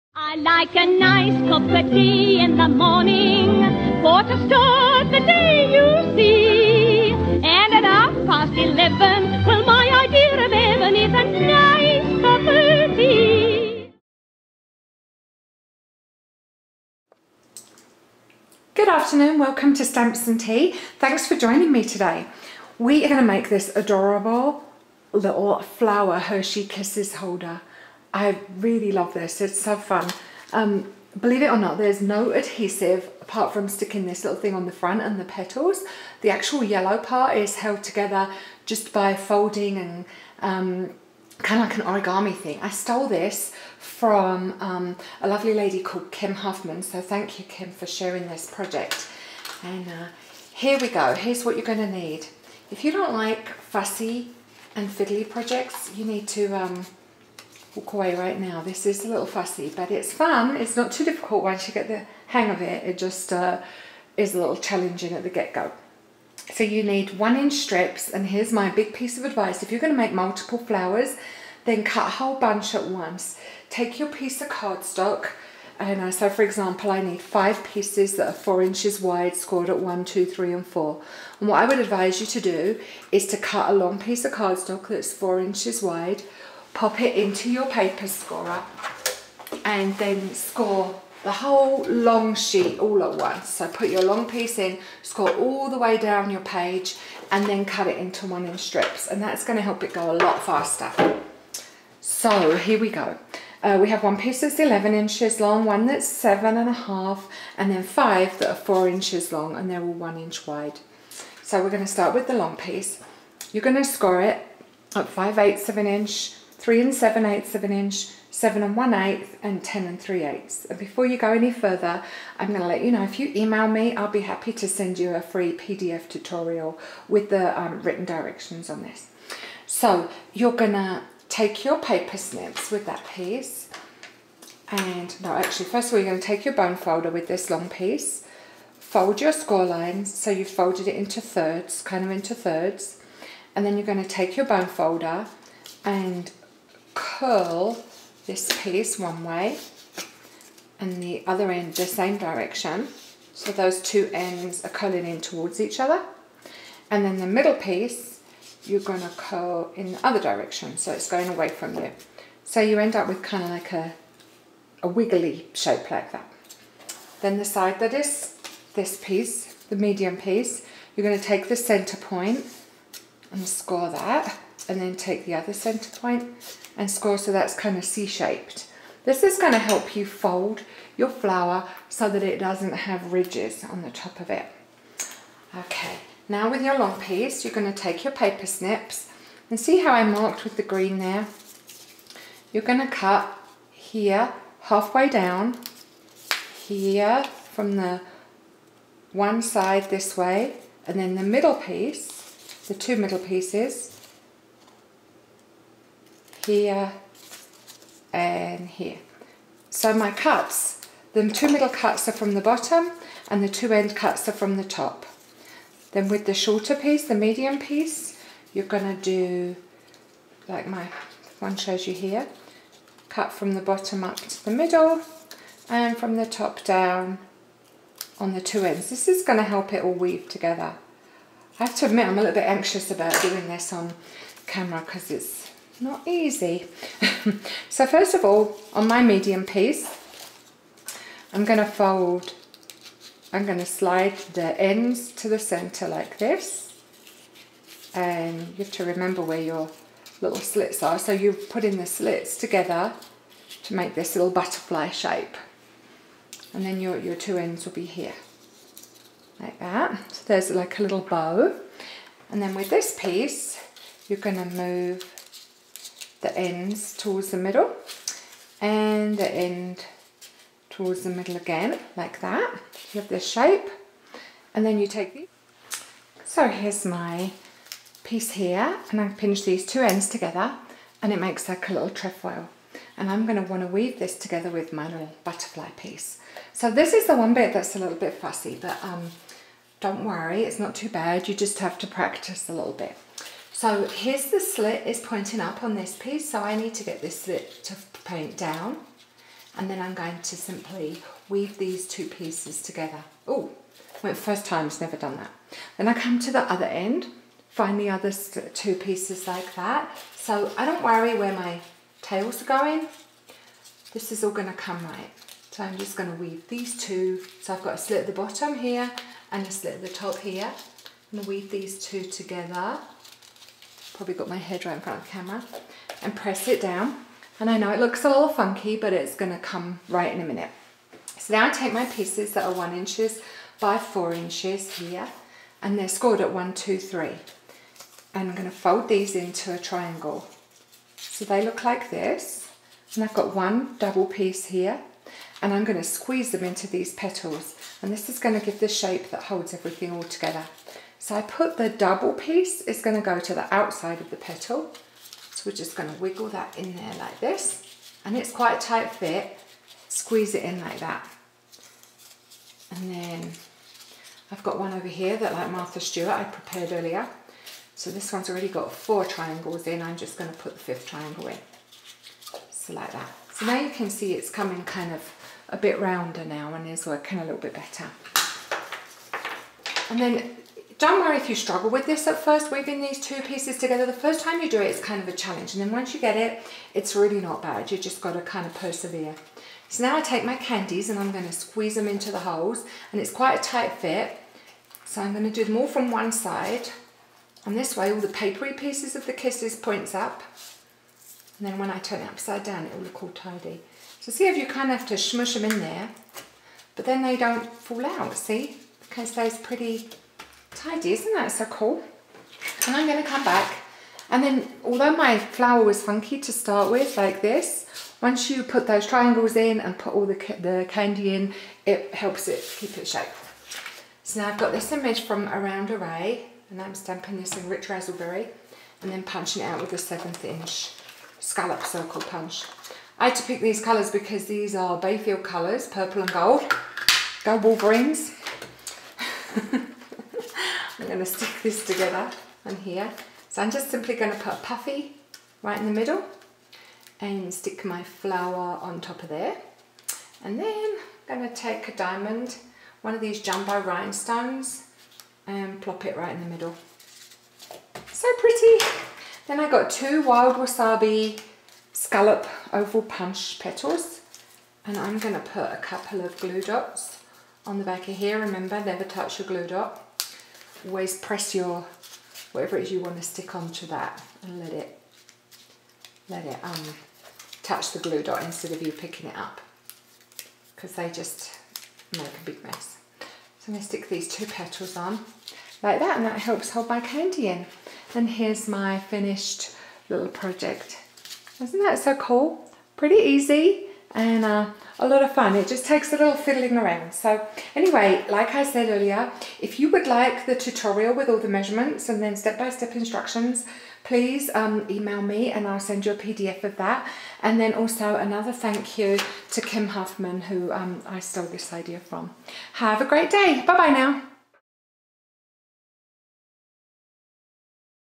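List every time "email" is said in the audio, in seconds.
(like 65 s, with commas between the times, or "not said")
123 s, 504 s.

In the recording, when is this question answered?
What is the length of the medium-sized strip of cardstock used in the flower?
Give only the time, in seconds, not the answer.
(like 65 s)
106 s.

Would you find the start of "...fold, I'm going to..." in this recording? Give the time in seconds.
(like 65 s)
241 s.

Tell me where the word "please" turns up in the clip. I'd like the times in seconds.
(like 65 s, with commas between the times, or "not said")
503 s.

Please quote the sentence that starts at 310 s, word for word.
So I don't worry where my tails are going.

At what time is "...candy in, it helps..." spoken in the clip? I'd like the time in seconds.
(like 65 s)
420 s.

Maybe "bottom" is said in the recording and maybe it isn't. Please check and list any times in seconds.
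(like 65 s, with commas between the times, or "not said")
212 s, 223 s, 318 s.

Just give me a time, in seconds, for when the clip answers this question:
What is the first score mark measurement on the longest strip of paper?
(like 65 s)
115 s.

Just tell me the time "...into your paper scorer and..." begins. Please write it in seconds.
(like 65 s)
87 s.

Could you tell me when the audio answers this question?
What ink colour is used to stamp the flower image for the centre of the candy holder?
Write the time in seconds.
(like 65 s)
427 s.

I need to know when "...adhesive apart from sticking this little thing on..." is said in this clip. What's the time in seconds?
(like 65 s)
32 s.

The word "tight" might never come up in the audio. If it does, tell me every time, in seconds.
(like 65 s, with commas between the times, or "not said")
358 s, 393 s.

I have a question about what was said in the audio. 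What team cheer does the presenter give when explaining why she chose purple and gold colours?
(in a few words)
Go Wolverines.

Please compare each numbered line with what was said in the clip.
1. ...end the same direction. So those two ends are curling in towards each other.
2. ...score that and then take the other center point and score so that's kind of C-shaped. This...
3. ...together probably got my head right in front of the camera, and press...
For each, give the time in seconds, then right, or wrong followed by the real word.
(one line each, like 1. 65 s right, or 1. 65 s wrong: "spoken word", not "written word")
1. 151 s right
2. 173 s right
3. 322 s right.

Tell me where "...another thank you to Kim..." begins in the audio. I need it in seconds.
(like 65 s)
507 s.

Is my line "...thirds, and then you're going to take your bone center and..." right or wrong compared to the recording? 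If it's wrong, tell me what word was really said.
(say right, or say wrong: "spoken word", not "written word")
wrong: "folder", not "center".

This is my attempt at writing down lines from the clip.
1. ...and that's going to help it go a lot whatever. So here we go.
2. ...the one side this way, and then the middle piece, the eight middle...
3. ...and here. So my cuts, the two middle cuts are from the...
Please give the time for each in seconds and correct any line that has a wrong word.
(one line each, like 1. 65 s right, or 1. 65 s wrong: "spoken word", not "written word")
1. 99 s wrong: "faster", not "whatever"
2. 197 s wrong: "two", not "eight"
3. 208 s right.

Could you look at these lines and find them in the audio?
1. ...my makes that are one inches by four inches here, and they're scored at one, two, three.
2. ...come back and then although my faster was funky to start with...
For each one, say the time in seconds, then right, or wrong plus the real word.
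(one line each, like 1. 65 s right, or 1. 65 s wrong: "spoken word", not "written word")
1. 331 s wrong: "pieces", not "makes"
2. 413 s wrong: "flower", not "faster".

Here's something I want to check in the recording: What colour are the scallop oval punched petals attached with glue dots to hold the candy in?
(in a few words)
Wild Wasabi.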